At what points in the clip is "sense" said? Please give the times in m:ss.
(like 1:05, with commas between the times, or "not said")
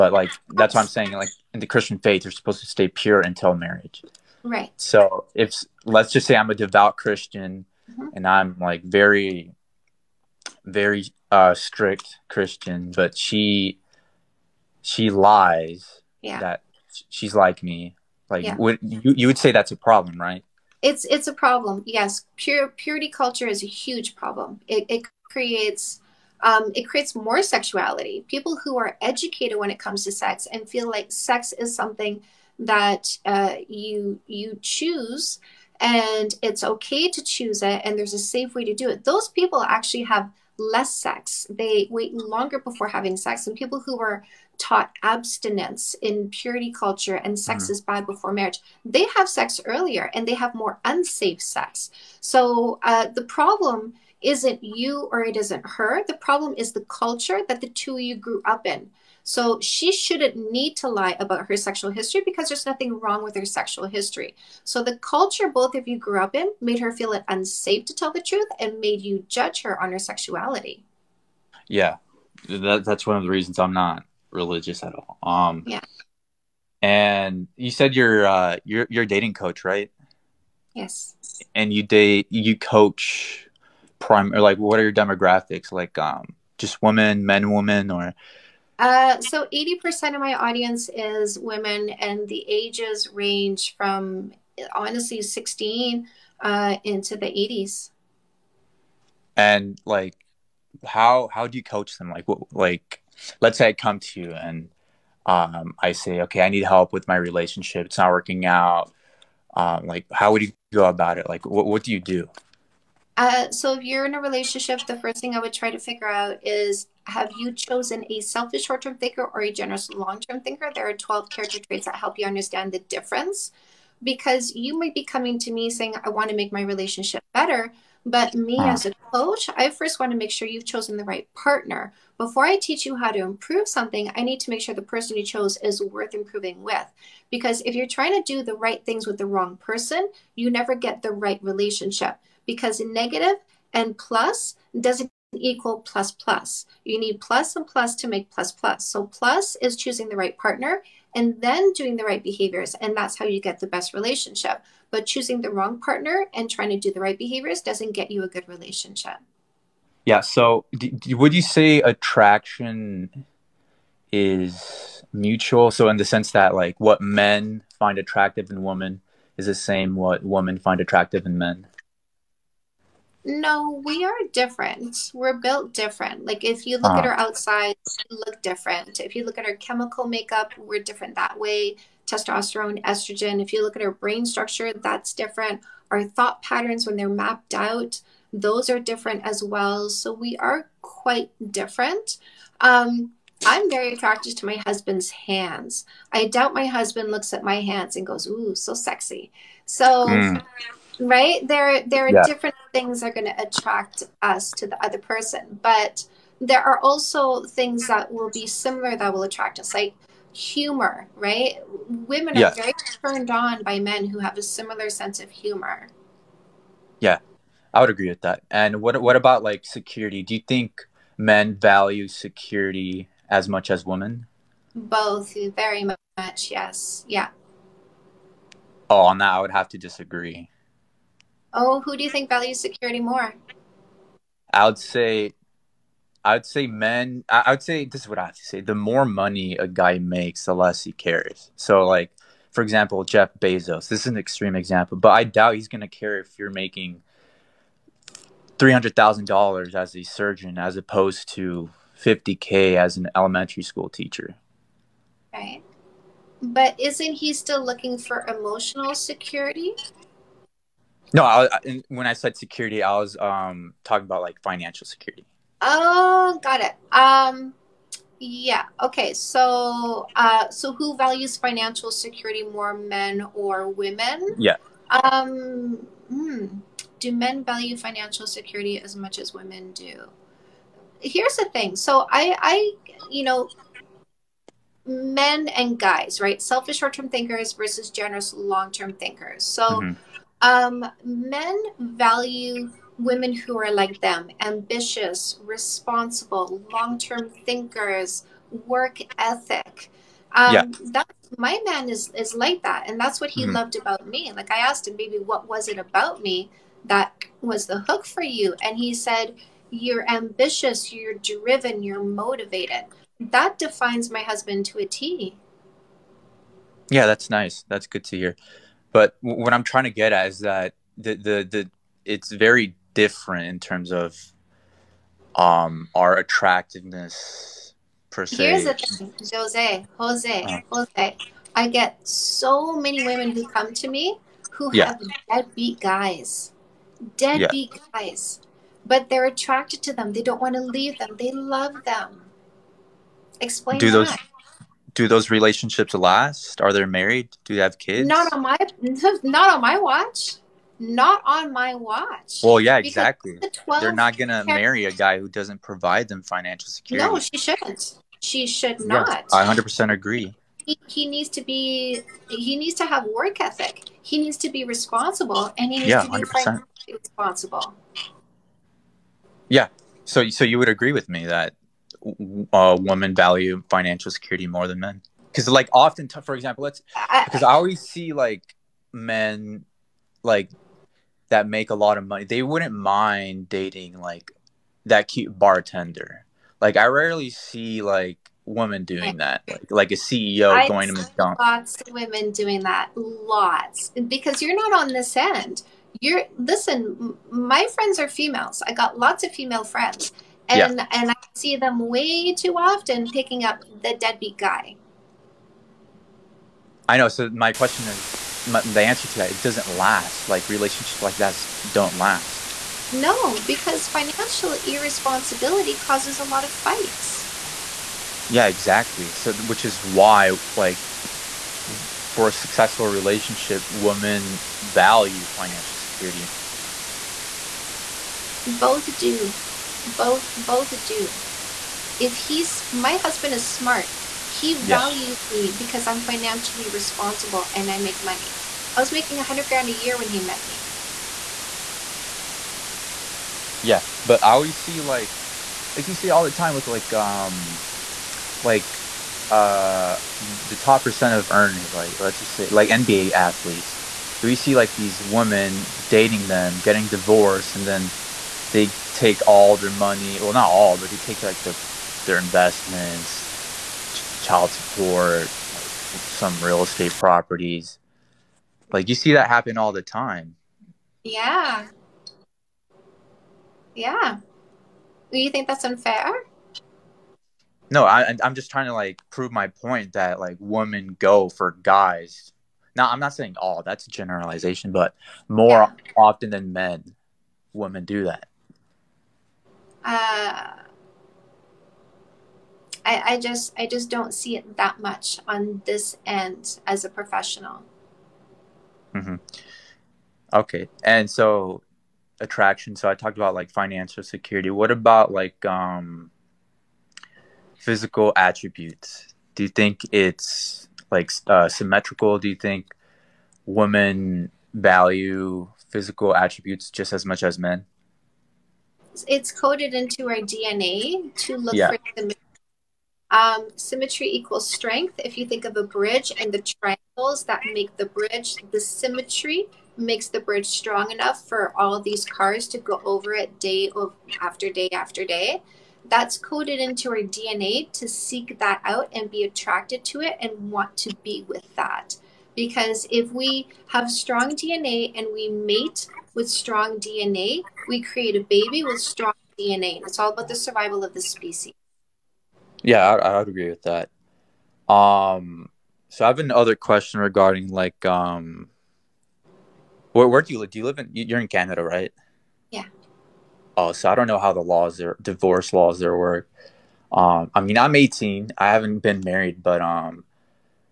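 2:46, 3:34.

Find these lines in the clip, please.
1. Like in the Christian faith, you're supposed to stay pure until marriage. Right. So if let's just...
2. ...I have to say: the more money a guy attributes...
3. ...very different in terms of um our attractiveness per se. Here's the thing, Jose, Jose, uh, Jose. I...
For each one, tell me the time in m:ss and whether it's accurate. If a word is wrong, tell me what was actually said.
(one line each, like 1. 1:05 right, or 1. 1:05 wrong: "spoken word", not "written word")
1. 0:01 right
2. 3:58 wrong: "makes", not "attributes"
3. 5:22 right.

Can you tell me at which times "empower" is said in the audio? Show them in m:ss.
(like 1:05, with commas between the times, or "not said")
not said.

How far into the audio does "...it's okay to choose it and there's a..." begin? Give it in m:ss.
0:36.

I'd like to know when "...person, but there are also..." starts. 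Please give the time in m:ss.
3:24.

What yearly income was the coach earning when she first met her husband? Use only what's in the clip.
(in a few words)
$100,000.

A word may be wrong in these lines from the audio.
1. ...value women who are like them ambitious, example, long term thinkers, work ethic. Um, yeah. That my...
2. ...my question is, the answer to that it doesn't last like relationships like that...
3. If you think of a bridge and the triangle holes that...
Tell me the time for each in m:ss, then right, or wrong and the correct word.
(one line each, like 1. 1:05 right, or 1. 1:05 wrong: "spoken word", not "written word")
1. 4:51 wrong: "responsible", not "example"
2. 6:47 right
3. 8:44 right.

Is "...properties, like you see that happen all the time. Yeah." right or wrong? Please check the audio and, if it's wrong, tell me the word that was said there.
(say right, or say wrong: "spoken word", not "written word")
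right.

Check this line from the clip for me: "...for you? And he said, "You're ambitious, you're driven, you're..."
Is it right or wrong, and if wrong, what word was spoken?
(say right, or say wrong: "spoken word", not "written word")
right.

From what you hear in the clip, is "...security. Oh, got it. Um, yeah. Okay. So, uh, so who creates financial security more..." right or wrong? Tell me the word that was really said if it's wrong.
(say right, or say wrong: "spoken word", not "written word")
wrong: "values", not "creates".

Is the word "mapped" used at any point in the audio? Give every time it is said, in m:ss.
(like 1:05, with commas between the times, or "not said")
3:07.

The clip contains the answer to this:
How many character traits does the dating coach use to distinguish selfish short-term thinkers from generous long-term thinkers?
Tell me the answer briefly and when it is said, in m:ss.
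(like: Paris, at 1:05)
12, at 2:00.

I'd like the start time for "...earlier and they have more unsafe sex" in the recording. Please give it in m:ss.
0:49.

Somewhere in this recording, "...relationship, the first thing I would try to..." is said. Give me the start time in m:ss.
1:54.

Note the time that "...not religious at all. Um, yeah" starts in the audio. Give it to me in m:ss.
1:13.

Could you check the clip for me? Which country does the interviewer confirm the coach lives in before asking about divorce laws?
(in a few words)
Canada.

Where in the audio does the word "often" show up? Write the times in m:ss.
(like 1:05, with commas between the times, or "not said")
6:15, 6:42, 8:05.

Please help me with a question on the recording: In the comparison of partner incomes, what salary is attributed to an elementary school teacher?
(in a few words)
$50k.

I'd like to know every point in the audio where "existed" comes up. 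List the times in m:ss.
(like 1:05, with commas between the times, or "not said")
not said.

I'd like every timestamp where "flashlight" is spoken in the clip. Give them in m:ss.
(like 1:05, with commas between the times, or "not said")
not said.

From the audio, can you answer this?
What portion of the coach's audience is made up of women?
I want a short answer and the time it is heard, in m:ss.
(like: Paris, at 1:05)
80%, at 1:29.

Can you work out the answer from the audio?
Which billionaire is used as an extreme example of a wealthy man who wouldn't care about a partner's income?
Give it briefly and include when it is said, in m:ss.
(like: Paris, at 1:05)
Jeff Bezos, at 4:03.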